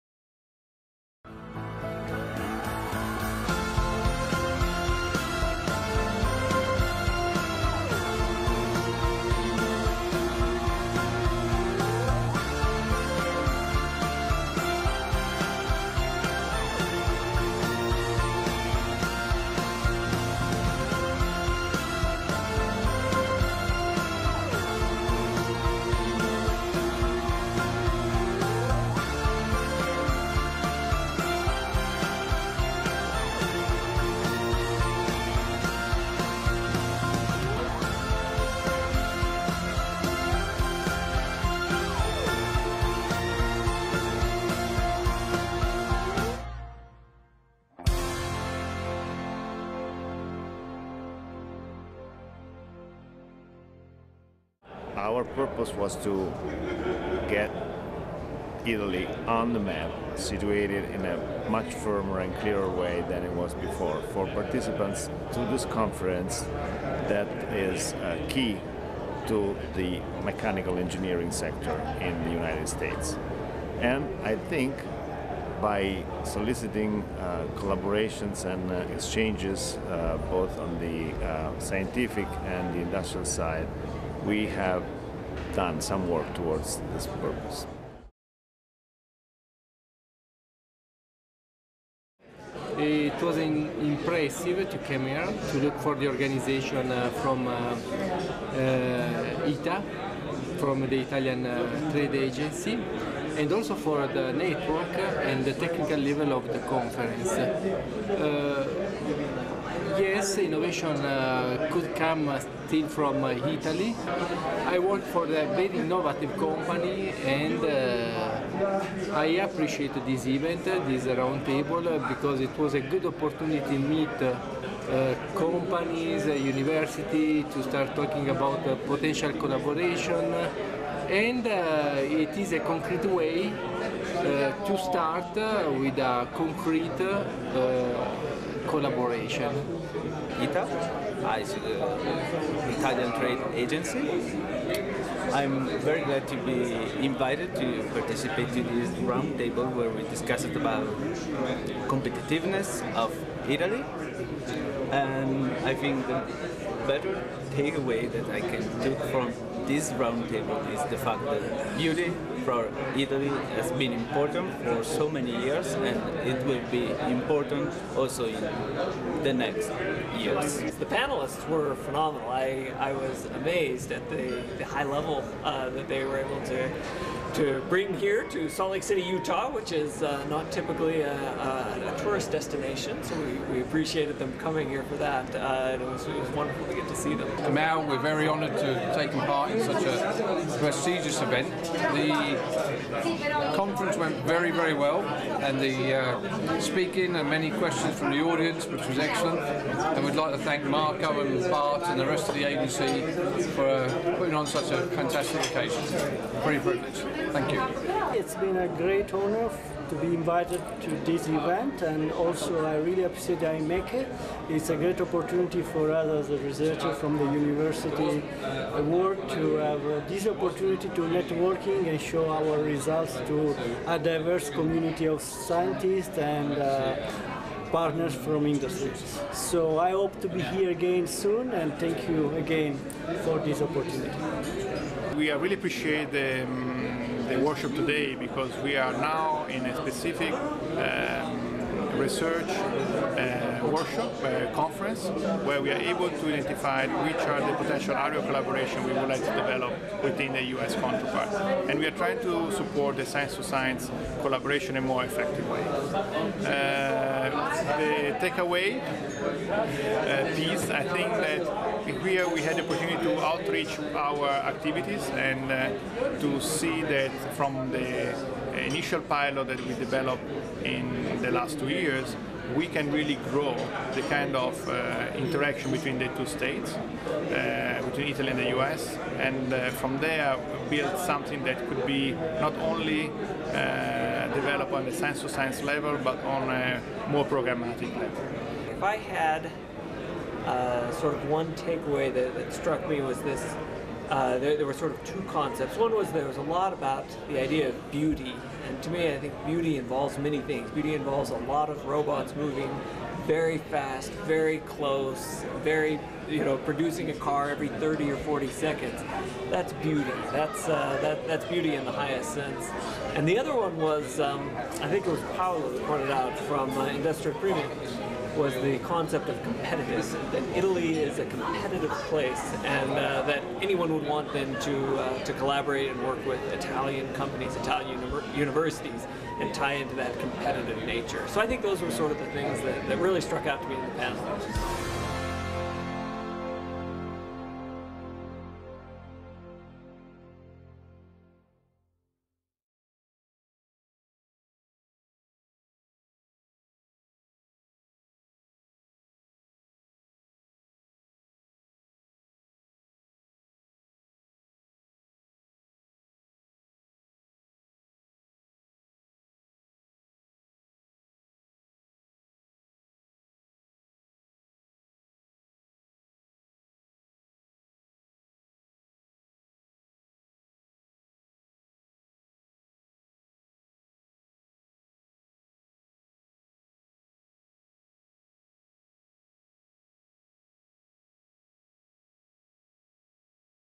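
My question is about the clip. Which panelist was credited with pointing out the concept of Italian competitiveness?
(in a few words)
Paolo.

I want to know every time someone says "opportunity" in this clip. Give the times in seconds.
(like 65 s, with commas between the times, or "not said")
123 s, 215 s, 220 s, 233 s, 262 s.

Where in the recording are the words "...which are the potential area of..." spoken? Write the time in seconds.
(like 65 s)
247 s.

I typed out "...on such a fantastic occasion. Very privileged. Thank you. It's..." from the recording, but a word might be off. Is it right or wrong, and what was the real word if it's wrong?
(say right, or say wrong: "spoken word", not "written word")
right.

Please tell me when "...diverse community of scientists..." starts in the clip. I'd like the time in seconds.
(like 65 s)
223 s.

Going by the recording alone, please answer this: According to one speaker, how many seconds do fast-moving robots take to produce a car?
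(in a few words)
30 or 40 seconds.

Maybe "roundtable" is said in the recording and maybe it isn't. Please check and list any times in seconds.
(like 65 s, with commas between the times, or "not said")
121 s, 149 s, 159 s.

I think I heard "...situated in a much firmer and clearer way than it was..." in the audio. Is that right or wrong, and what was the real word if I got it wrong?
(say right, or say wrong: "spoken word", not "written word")
right.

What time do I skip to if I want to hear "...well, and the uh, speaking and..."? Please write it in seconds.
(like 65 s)
194 s.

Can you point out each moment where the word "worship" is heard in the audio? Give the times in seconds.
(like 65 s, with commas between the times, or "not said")
237 s.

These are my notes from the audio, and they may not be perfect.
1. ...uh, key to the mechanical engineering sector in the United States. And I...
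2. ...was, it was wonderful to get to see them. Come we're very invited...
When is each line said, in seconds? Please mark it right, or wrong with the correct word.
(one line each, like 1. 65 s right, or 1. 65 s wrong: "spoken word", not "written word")
1. 67 s right
2. 185 s wrong: "honored", not "invited".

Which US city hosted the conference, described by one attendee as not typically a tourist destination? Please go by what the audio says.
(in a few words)
Salt Lake City.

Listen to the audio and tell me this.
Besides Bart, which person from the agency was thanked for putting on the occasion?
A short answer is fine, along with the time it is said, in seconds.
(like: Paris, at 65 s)
Marco, at 200 s.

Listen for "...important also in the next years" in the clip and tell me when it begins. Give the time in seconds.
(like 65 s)
167 s.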